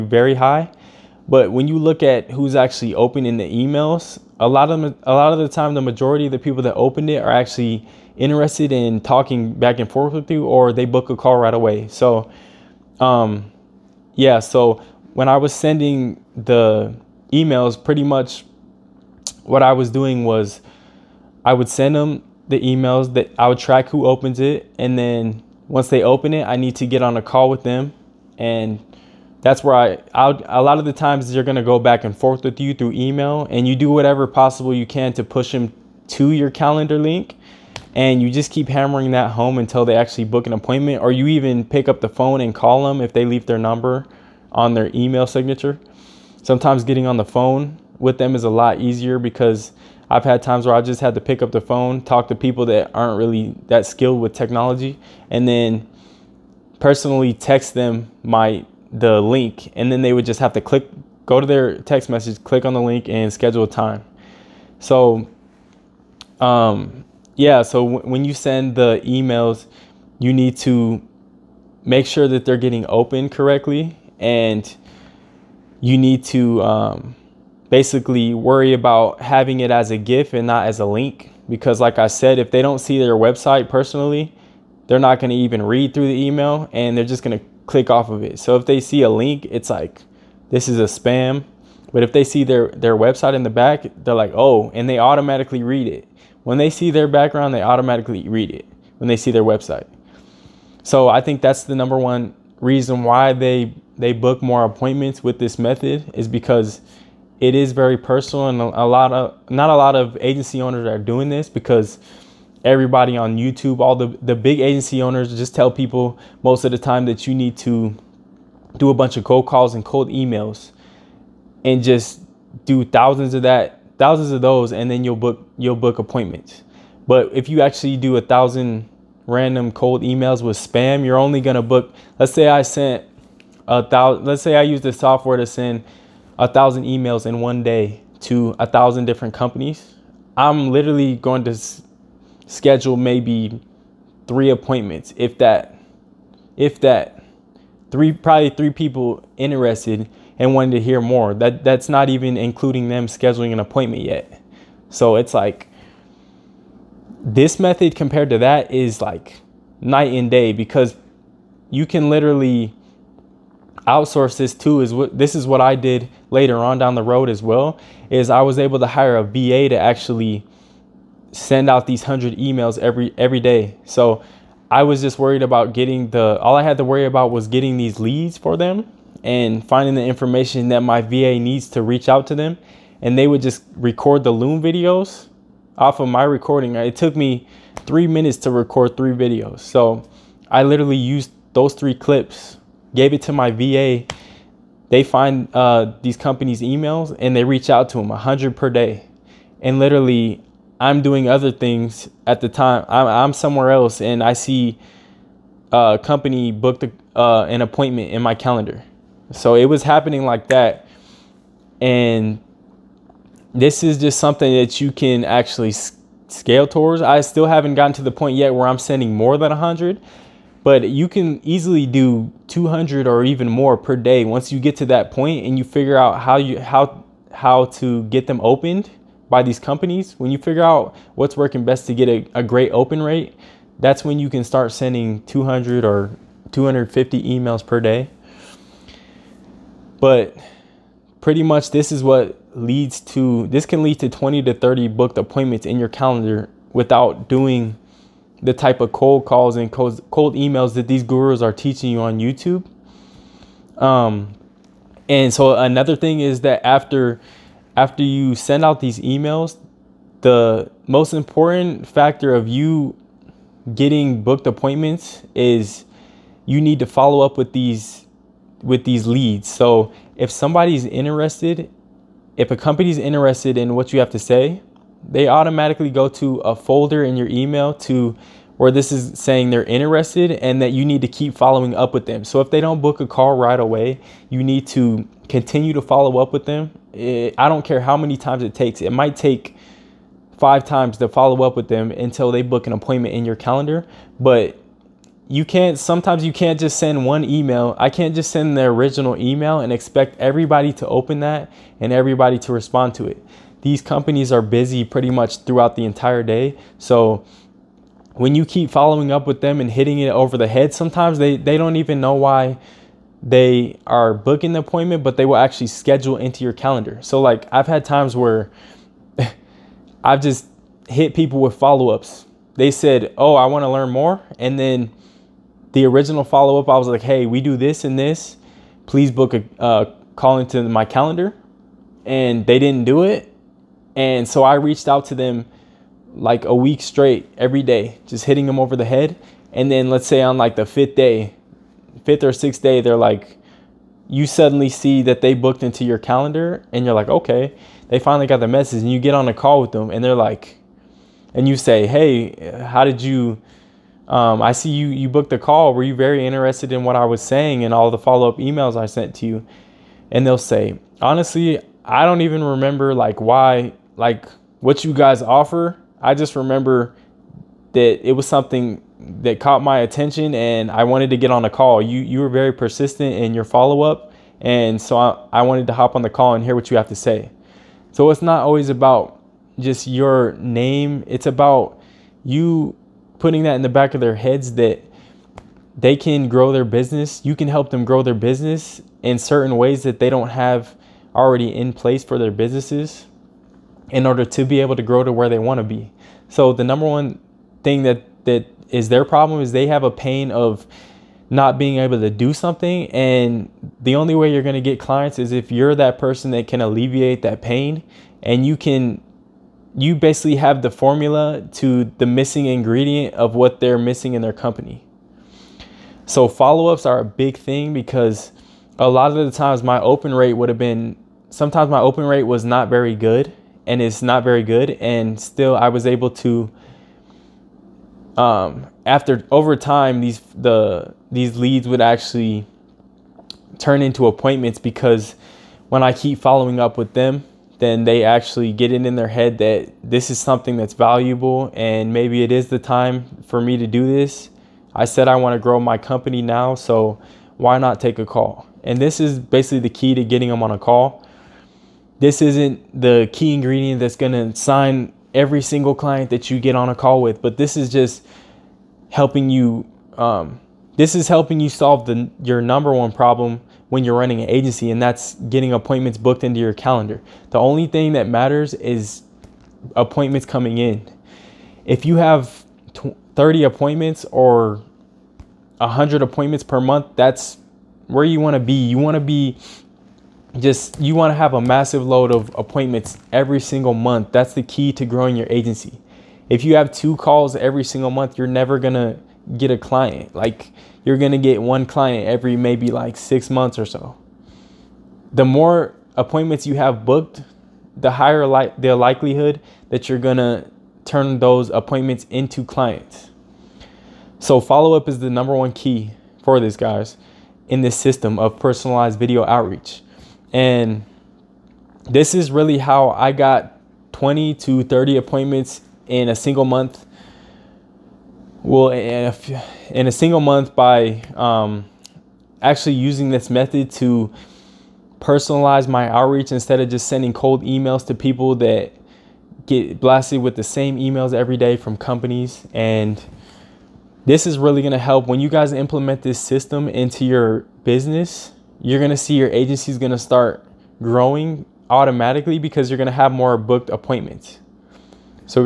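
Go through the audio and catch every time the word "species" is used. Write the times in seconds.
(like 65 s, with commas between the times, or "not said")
not said.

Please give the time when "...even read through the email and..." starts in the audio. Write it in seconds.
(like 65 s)
85 s.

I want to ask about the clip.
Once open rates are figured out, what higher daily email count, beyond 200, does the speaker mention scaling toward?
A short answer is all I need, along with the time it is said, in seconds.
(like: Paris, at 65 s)
250, at 236 s.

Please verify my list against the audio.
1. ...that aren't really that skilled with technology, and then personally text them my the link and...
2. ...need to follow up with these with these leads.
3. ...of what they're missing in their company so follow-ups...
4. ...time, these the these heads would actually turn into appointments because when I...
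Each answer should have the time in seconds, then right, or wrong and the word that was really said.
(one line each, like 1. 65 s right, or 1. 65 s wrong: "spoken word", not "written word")
1. 52 s right
2. 266 s right
3. 413 s right
4. 429 s wrong: "leads", not "heads".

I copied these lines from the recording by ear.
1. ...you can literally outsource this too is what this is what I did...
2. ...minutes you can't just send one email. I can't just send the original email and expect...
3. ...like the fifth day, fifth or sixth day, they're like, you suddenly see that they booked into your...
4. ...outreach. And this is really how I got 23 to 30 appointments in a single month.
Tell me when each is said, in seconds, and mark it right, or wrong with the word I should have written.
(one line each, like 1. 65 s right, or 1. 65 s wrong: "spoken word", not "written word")
1. 161 s right
2. 295 s wrong: "sometimes", not "minutes"
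3. 340 s right
4. 509 s wrong: "20", not "23".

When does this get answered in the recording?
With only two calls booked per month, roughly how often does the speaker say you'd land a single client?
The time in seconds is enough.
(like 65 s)
492 s.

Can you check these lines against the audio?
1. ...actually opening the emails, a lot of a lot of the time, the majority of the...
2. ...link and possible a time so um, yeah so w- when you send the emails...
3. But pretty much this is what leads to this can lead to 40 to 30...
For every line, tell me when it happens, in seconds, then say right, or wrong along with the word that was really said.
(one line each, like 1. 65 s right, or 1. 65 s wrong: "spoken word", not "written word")
1. 2 s right
2. 62 s wrong: "schedule", not "possible"
3. 239 s wrong: "20", not "40".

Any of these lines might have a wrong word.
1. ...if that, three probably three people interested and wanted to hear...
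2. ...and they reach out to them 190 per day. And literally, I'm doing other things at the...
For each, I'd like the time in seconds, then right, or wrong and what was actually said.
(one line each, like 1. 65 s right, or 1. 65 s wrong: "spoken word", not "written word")
1. 146 s right
2. 197 s wrong: "100", not "190".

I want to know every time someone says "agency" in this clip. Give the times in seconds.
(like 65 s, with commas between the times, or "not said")
110 s, 114 s, 464 s, 485 s, 539 s.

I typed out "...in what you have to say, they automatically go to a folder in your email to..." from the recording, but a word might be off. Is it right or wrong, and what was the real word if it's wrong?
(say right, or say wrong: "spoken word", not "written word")
right.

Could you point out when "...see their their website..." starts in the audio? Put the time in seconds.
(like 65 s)
92 s.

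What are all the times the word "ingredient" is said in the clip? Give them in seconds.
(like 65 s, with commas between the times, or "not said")
412 s, 453 s.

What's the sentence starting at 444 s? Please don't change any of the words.
I said I want to grow my company now, so why not take a call?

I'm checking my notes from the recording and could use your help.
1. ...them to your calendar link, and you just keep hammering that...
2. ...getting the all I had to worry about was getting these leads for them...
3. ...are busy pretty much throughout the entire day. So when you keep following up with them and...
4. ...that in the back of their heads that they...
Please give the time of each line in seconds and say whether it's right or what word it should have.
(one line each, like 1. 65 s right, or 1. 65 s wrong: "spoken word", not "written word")
1. 35 s right
2. 175 s right
3. 304 s right
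4. 383 s right.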